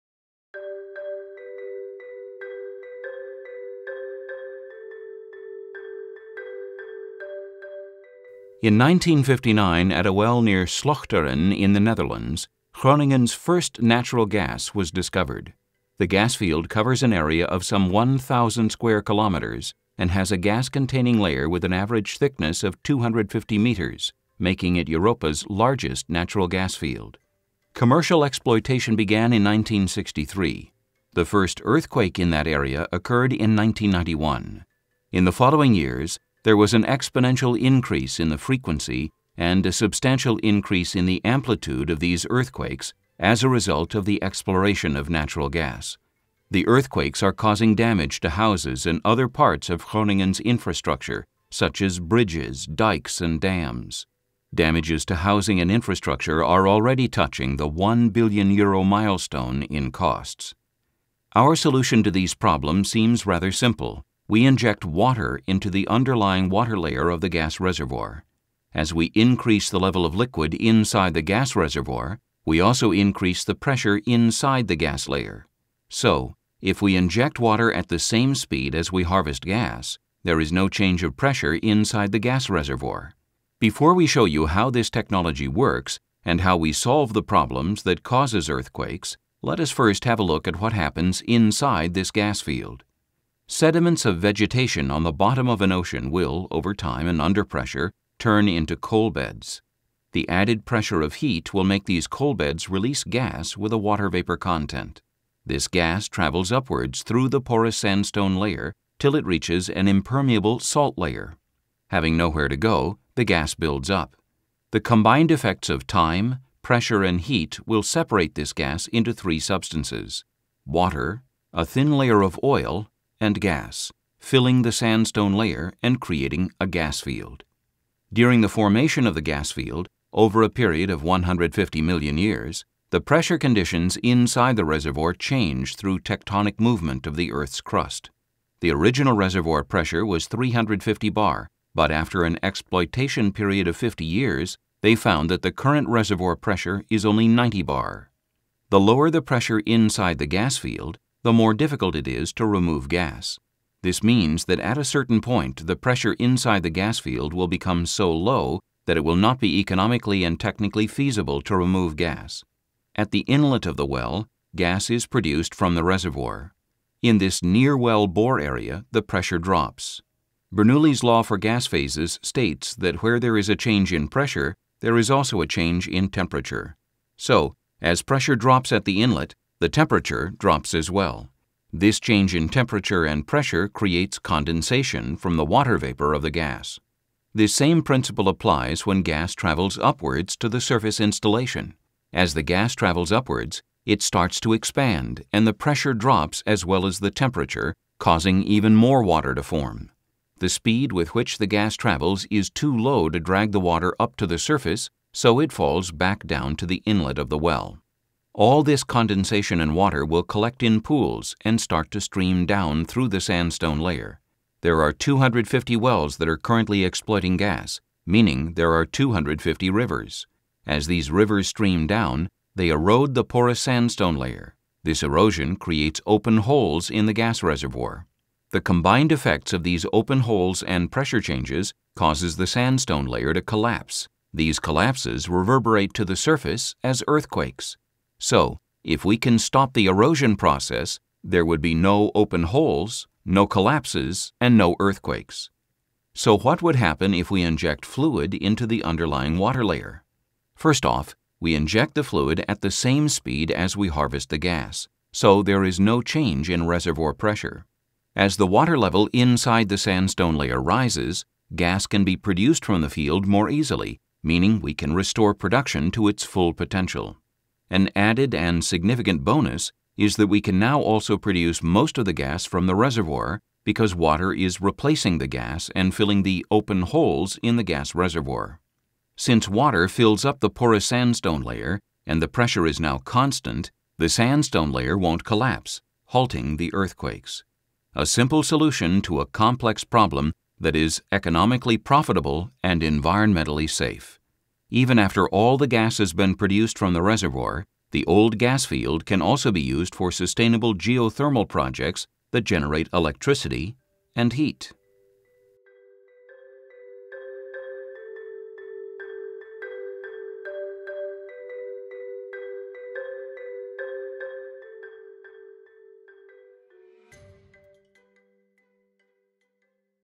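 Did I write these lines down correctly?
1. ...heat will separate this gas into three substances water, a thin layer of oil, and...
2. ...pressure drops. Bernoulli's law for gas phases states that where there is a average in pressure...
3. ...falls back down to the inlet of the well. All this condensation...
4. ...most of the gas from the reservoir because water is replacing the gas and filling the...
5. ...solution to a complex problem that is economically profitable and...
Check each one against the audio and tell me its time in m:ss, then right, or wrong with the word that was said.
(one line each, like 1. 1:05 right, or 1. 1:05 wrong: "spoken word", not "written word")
1. 1:57 right
2. 2:49 wrong: "change", not "average"
3. 3:25 right
4. 4:31 right
5. 4:48 right.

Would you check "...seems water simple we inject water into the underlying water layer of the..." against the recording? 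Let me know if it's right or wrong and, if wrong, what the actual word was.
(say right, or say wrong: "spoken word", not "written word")
wrong: "rather", not "water".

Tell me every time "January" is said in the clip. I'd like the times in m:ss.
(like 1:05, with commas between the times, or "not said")
not said.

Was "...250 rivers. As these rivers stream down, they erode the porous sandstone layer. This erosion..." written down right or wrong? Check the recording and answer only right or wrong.
right.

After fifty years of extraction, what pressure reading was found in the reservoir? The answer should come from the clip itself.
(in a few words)
90 bar.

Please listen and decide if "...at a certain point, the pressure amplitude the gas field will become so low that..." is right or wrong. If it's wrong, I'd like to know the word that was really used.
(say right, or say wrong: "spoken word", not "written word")
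wrong: "inside", not "amplitude".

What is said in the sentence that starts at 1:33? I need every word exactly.
Sediments of vegetation on the bottom of an ocean will, over time and under pressure, turn into coal beds.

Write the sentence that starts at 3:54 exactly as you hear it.
These collapses reverberate to the surface as earthquakes.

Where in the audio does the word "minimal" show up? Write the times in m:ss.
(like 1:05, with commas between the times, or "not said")
not said.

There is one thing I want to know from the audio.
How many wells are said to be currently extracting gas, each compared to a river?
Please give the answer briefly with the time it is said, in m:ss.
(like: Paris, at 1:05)
250, at 3:34.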